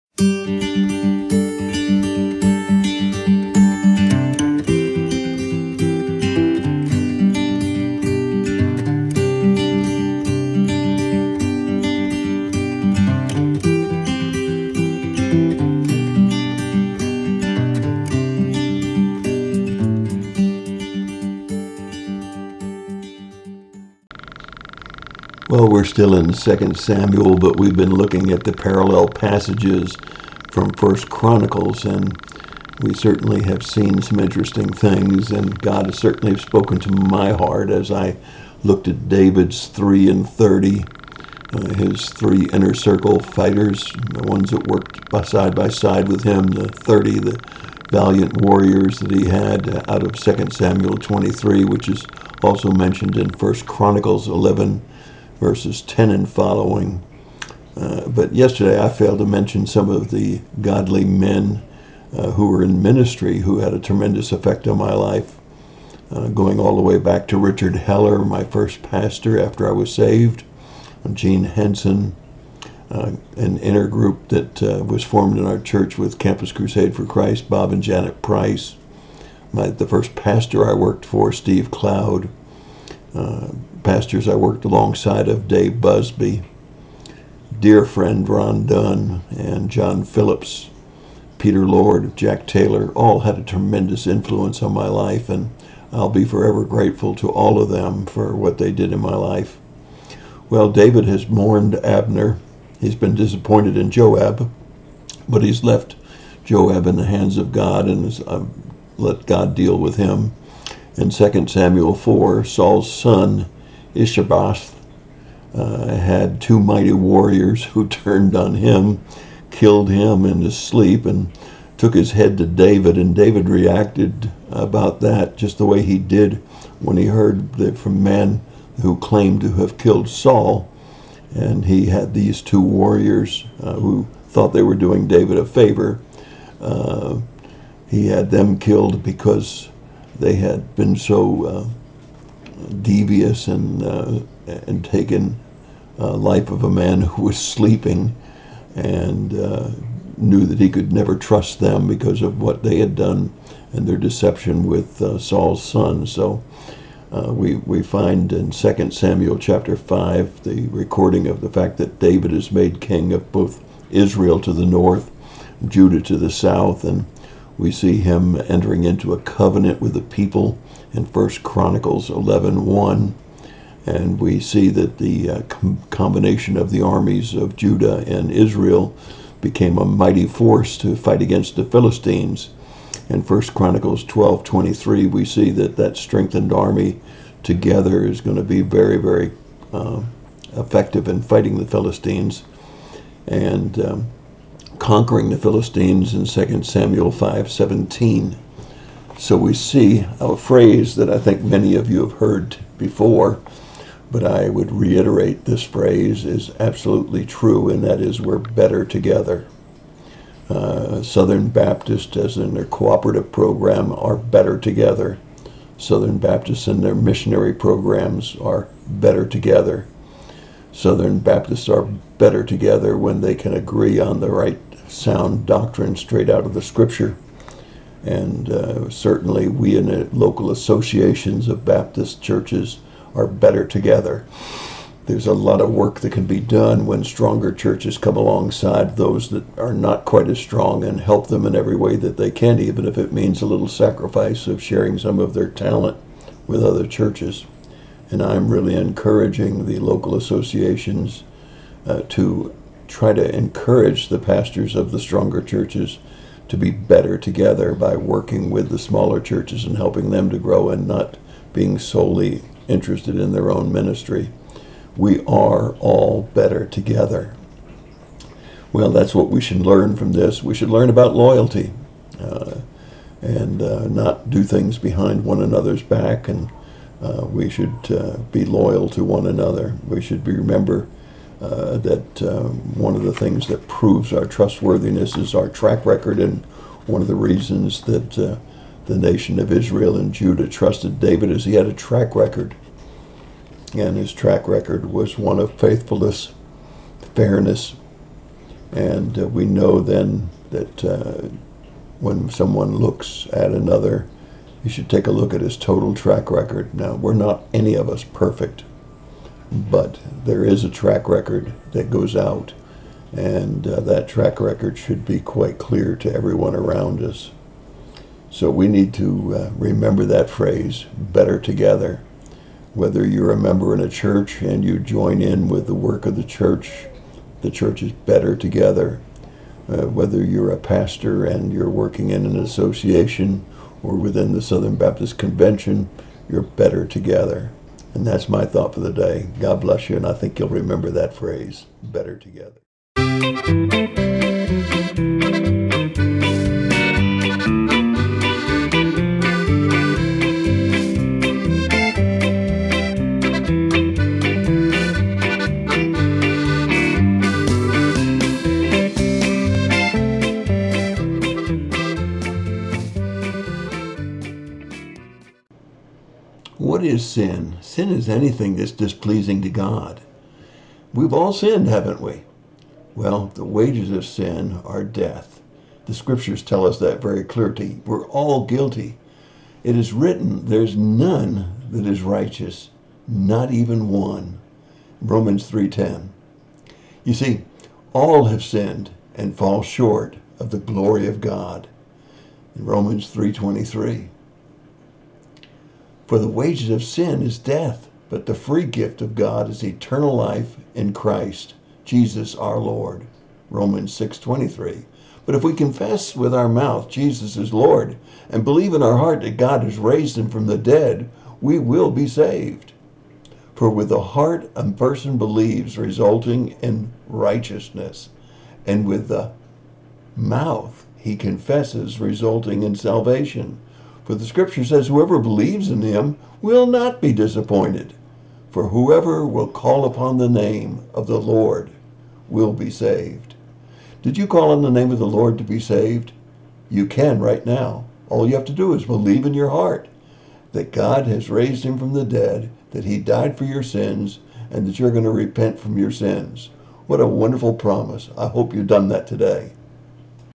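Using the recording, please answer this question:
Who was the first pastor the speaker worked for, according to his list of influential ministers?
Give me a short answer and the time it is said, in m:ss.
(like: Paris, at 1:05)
Steve Cloud, at 1:21.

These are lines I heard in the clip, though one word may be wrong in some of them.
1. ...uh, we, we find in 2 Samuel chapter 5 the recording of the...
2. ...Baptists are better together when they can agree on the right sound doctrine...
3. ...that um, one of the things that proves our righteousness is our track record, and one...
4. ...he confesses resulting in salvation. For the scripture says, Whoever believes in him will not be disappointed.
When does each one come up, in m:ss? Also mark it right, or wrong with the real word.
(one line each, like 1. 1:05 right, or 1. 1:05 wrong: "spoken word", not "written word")
1. 2:37 right
2. 3:41 right
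3. 4:41 wrong: "trustworthiness", not "righteousness"
4. 7:00 right.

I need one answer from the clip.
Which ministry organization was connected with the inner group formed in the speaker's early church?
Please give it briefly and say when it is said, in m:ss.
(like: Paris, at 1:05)
Campus Crusade for Christ, at 1:16.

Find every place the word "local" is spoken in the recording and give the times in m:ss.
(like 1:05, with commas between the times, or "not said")
3:50, 4:09.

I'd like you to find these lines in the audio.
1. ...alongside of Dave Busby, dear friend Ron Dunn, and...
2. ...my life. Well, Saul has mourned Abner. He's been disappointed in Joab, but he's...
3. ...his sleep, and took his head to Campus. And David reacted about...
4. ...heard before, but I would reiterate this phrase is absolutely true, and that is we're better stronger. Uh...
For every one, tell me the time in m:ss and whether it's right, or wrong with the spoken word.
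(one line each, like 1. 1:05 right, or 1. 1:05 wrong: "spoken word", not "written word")
1. 1:24 right
2. 1:39 wrong: "David", not "Saul"
3. 2:00 wrong: "David", not "Campus"
4. 3:22 wrong: "together", not "stronger".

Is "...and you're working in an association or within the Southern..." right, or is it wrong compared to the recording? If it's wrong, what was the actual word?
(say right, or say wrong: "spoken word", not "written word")
right.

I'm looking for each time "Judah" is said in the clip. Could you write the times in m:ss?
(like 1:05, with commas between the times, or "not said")
2:45, 2:57, 4:50.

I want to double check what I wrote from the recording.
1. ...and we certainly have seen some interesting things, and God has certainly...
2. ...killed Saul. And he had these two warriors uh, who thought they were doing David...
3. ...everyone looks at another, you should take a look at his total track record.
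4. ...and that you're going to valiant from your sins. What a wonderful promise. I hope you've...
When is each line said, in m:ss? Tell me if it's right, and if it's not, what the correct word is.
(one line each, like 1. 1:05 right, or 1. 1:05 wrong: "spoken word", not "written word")
1. 0:31 right
2. 2:09 right
3. 5:02 wrong: "someone", not "everyone"
4. 7:24 wrong: "repent", not "valiant".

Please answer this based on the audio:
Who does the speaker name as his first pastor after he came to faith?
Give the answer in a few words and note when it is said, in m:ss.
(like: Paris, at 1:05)
Richard Heller, at 1:07.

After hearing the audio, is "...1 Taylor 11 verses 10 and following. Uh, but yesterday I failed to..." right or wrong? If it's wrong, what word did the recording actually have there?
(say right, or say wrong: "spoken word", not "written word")
wrong: "Chronicles", not "Taylor".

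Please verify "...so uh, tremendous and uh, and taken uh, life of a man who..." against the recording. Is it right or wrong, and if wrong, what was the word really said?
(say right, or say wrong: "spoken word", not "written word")
wrong: "devious", not "tremendous".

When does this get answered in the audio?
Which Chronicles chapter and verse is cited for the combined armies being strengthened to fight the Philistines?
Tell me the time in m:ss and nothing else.
3:03.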